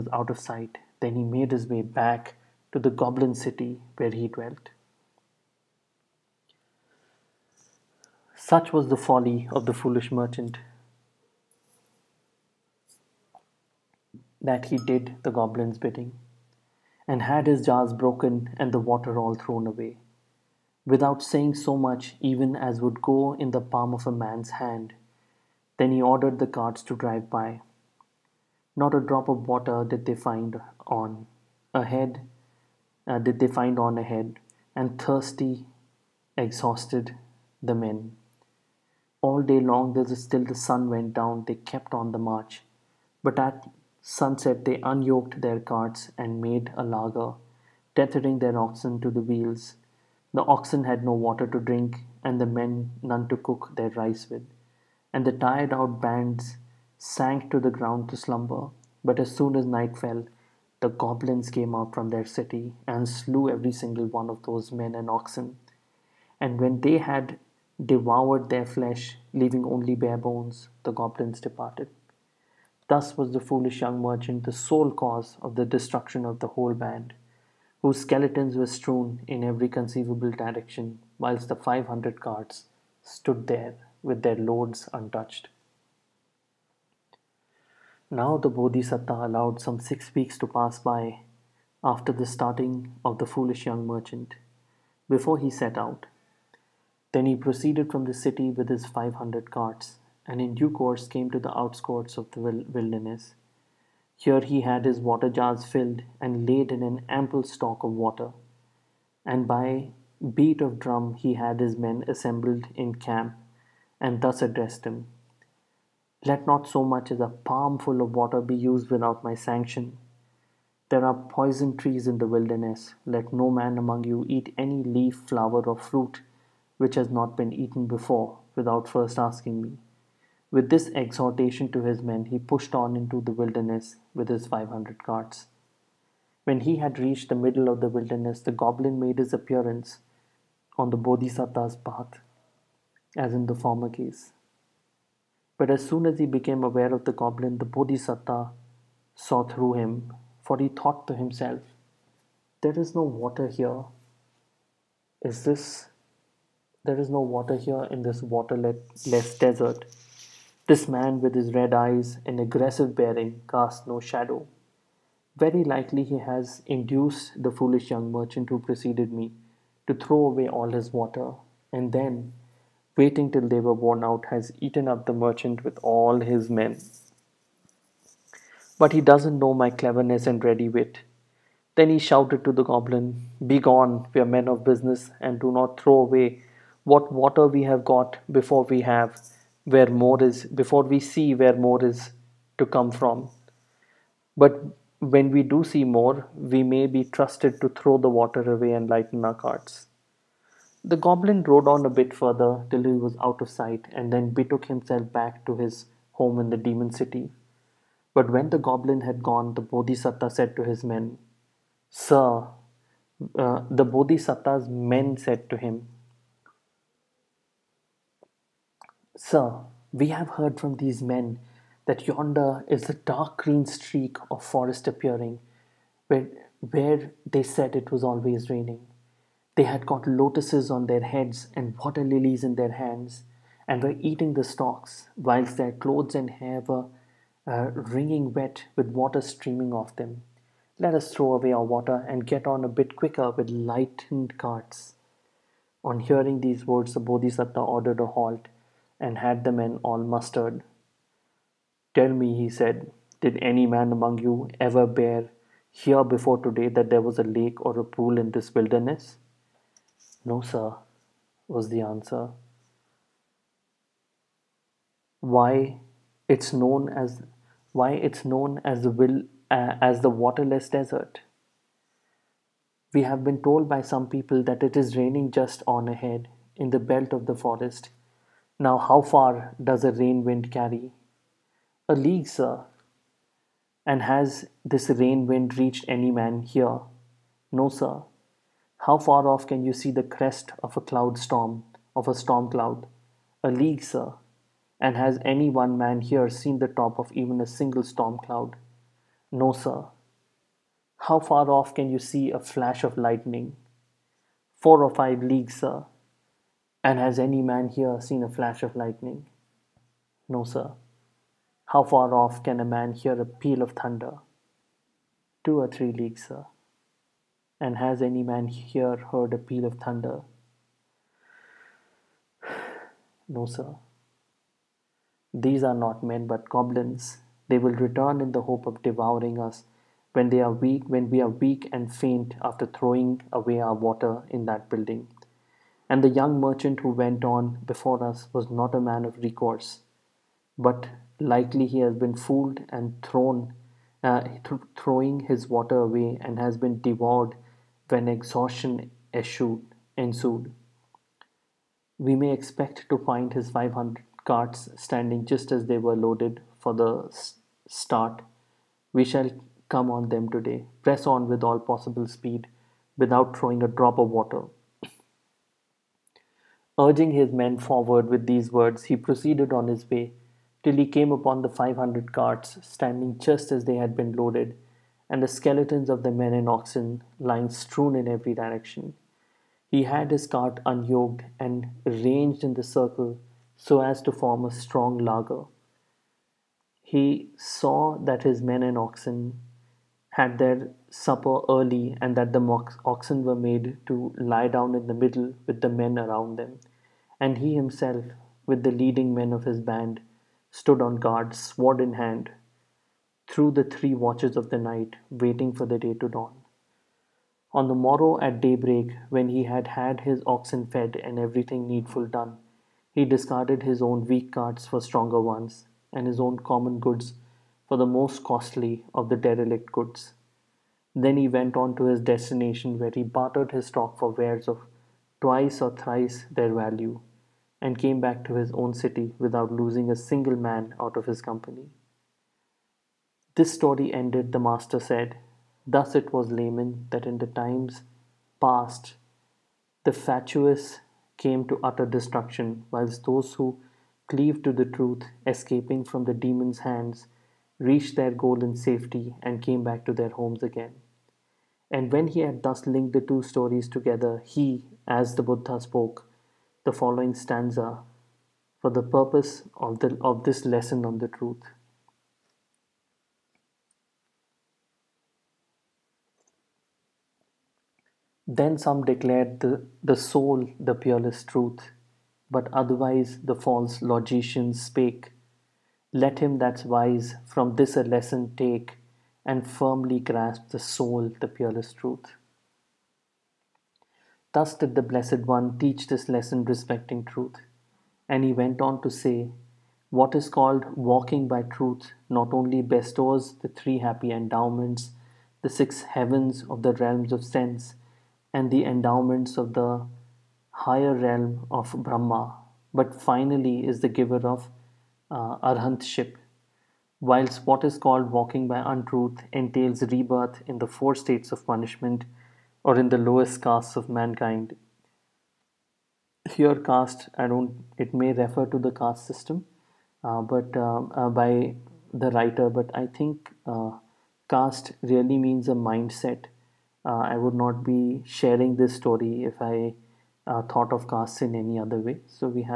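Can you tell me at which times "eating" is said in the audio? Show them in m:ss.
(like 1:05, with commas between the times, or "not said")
3:53.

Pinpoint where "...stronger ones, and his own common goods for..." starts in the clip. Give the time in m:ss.
6:54.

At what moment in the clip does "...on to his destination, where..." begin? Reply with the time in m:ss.
7:01.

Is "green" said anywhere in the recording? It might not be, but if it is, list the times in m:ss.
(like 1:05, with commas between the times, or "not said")
3:43.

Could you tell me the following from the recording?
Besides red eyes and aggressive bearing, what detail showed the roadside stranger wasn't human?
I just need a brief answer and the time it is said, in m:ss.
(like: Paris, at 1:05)
Casts no shadow, at 2:43.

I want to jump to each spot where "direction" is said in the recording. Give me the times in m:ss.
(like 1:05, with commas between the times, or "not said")
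1:20, 6:18.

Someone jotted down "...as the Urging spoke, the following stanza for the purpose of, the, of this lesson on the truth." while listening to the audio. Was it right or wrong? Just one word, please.
wrong.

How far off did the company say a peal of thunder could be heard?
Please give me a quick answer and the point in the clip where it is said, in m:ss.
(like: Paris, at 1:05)
Two or three leagues, at 5:15.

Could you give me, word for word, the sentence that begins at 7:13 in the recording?
This story ended, the master said.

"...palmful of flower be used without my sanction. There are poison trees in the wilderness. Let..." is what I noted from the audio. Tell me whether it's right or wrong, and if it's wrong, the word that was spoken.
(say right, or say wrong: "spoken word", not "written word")
wrong: "water", not "flower".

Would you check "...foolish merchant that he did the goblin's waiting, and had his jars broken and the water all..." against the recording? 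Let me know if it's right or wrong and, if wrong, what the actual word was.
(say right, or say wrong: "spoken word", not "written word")
wrong: "bidding", not "waiting".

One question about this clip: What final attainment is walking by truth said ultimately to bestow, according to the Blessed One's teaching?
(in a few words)
Arhantship.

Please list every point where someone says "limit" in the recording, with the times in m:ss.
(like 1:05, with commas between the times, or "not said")
not said.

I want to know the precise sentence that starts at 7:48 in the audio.
Then some declared the, the sole the peerless truth, but otherwise the false logicians spake.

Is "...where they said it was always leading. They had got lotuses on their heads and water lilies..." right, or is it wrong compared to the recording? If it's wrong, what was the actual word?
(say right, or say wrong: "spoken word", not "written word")
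wrong: "raining", not "leading".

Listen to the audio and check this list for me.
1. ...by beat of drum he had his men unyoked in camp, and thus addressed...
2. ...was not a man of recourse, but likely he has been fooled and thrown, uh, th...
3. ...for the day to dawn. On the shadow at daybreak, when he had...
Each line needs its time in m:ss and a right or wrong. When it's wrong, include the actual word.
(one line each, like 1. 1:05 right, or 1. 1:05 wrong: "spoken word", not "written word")
1. 1:49 wrong: "assembled", not "unyoked"
2. 5:38 right
3. 6:45 wrong: "morrow", not "shadow".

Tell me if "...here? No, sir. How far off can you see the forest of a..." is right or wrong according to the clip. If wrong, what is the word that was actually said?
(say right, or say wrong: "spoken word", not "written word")
wrong: "crest", not "forest".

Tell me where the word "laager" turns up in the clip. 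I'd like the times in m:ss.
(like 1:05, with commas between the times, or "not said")
0:46, 6:24.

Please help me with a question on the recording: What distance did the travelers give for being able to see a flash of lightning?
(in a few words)
Four or five leagues.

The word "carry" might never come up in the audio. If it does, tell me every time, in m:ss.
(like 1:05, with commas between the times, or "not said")
4:40.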